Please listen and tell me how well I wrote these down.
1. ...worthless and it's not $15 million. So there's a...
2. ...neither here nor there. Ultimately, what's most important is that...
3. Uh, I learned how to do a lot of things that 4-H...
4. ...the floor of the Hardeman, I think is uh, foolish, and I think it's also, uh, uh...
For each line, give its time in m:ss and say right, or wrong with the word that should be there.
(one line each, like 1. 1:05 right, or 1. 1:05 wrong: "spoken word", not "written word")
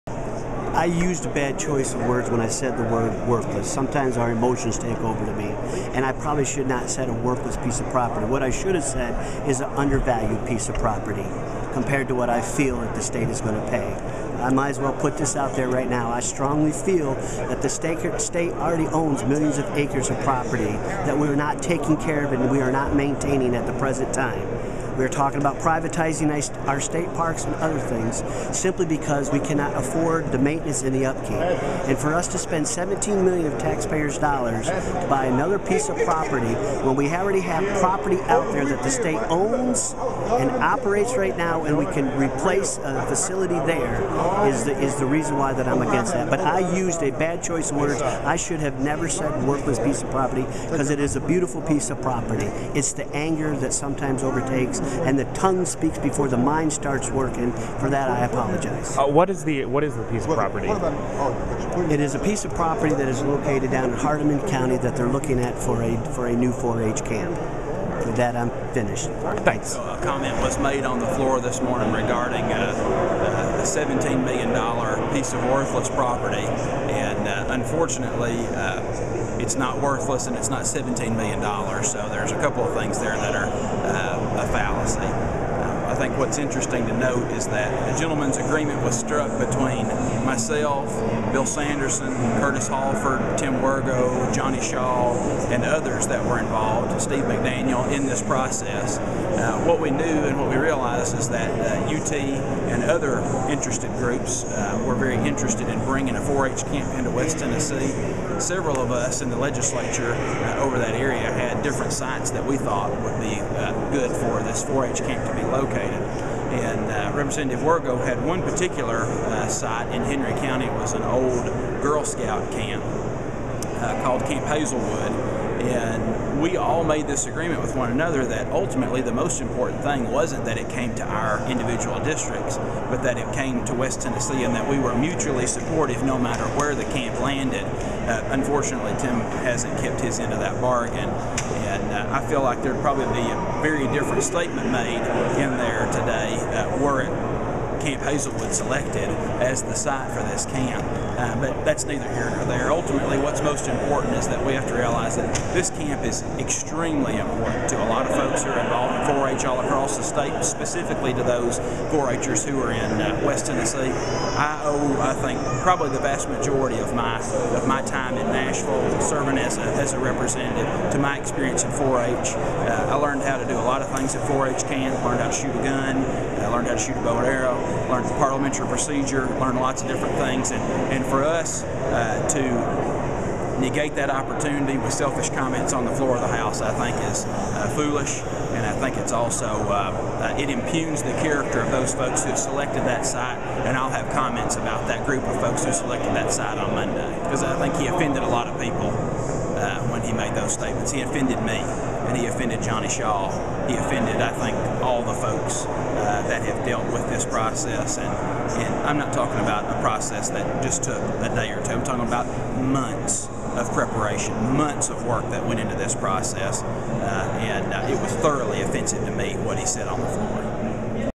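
1. 1:19 wrong: "17", not "15"
2. 2:31 right
3. 2:52 right
4. 3:05 wrong: "House", not "Hardeman".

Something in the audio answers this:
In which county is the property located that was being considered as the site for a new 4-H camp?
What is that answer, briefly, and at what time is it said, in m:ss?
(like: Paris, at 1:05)
Hardeman County, at 1:03.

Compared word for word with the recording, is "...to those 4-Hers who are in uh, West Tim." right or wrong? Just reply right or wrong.
wrong.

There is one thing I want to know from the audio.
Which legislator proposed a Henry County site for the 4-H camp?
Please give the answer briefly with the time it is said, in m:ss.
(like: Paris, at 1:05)
Tim Wirgau, at 1:57.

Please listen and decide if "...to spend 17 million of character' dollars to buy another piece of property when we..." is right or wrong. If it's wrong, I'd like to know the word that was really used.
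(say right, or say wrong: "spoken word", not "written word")
wrong: "taxpayers", not "character".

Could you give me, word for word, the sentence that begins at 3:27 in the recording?
And, and I'm not talking about a process that just took a day or two.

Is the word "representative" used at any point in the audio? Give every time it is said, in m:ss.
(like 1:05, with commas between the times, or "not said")
1:57, 2:49.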